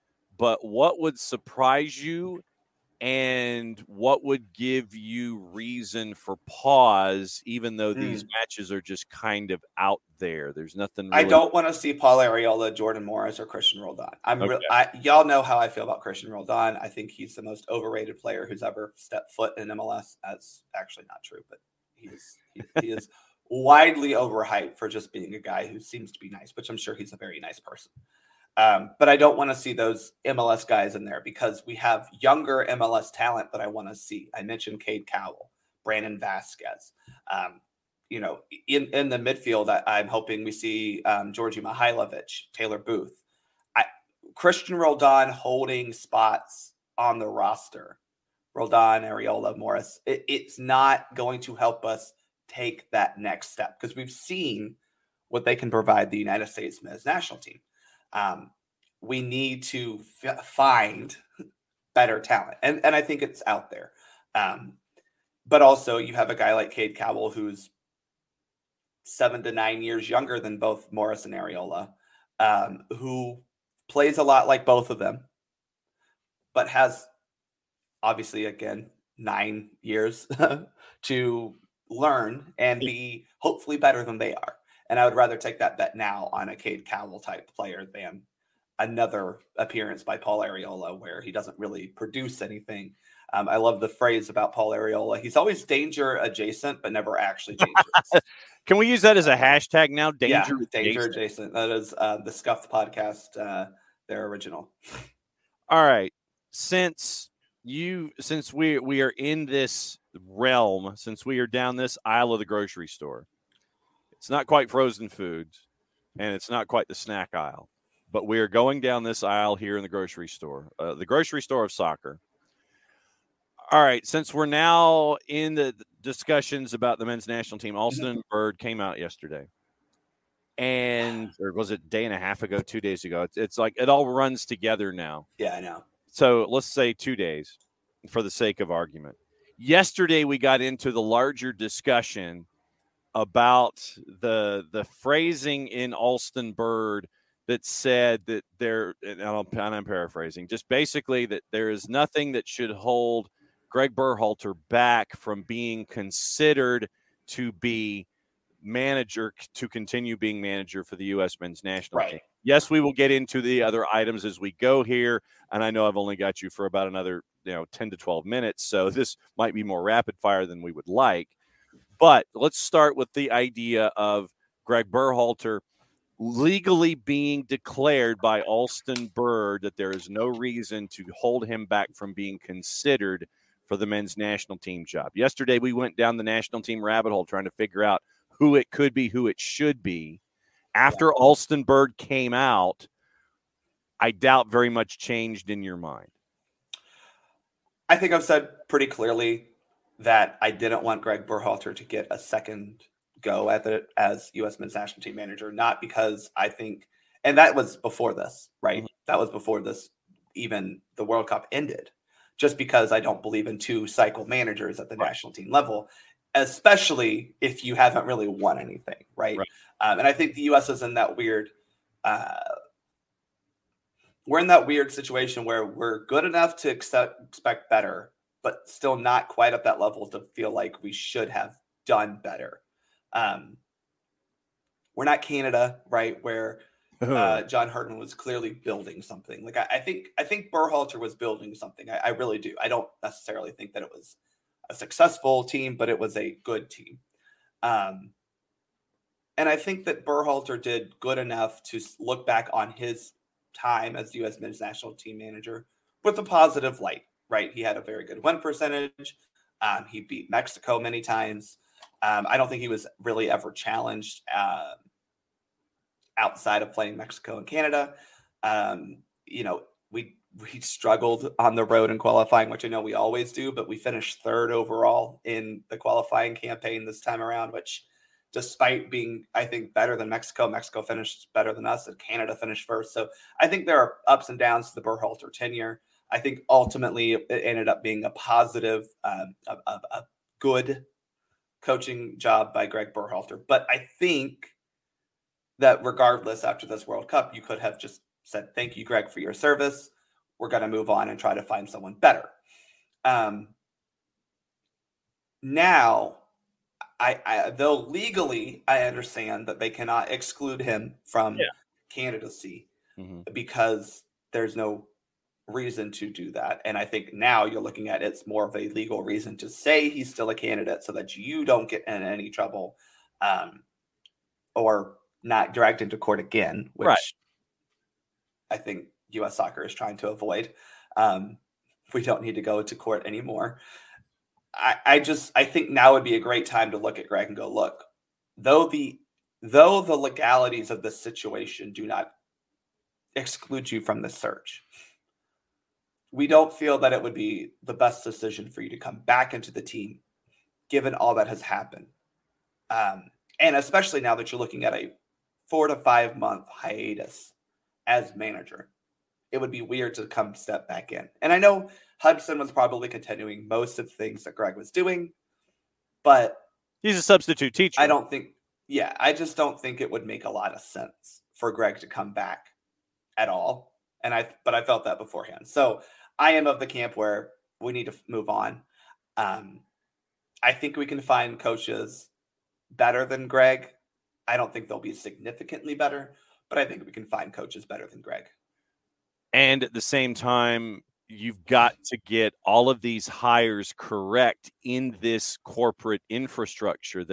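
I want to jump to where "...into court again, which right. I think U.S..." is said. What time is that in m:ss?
5:25.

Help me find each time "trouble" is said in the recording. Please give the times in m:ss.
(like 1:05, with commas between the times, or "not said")
5:22.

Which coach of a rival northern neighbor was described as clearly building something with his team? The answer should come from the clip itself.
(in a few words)
John Herdman.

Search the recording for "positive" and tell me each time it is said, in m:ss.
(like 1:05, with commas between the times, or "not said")
4:16, 4:48.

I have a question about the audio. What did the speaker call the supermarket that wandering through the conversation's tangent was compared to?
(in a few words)
the grocery store of soccer.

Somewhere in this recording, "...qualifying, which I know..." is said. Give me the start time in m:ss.
4:31.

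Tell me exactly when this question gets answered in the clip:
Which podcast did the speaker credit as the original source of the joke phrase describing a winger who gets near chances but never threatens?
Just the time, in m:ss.
1:42.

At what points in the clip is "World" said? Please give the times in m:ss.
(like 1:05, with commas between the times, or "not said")
3:31, 4:56.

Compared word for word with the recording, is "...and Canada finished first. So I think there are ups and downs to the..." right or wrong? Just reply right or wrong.
right.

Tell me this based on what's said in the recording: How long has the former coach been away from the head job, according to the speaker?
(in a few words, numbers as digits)
4 to 5 months.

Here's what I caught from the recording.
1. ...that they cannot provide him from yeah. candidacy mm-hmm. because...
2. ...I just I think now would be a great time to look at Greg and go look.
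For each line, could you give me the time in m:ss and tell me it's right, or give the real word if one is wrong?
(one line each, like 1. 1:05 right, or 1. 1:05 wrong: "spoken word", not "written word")
1. 5:09 wrong: "exclude", not "provide"
2. 5:34 right.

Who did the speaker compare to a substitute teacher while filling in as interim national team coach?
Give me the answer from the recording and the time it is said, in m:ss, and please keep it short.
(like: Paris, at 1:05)
Hudson, at 6:01.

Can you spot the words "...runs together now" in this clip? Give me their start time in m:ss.
2:14.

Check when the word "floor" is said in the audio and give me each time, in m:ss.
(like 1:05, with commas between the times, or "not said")
not said.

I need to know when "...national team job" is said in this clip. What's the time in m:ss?
3:04.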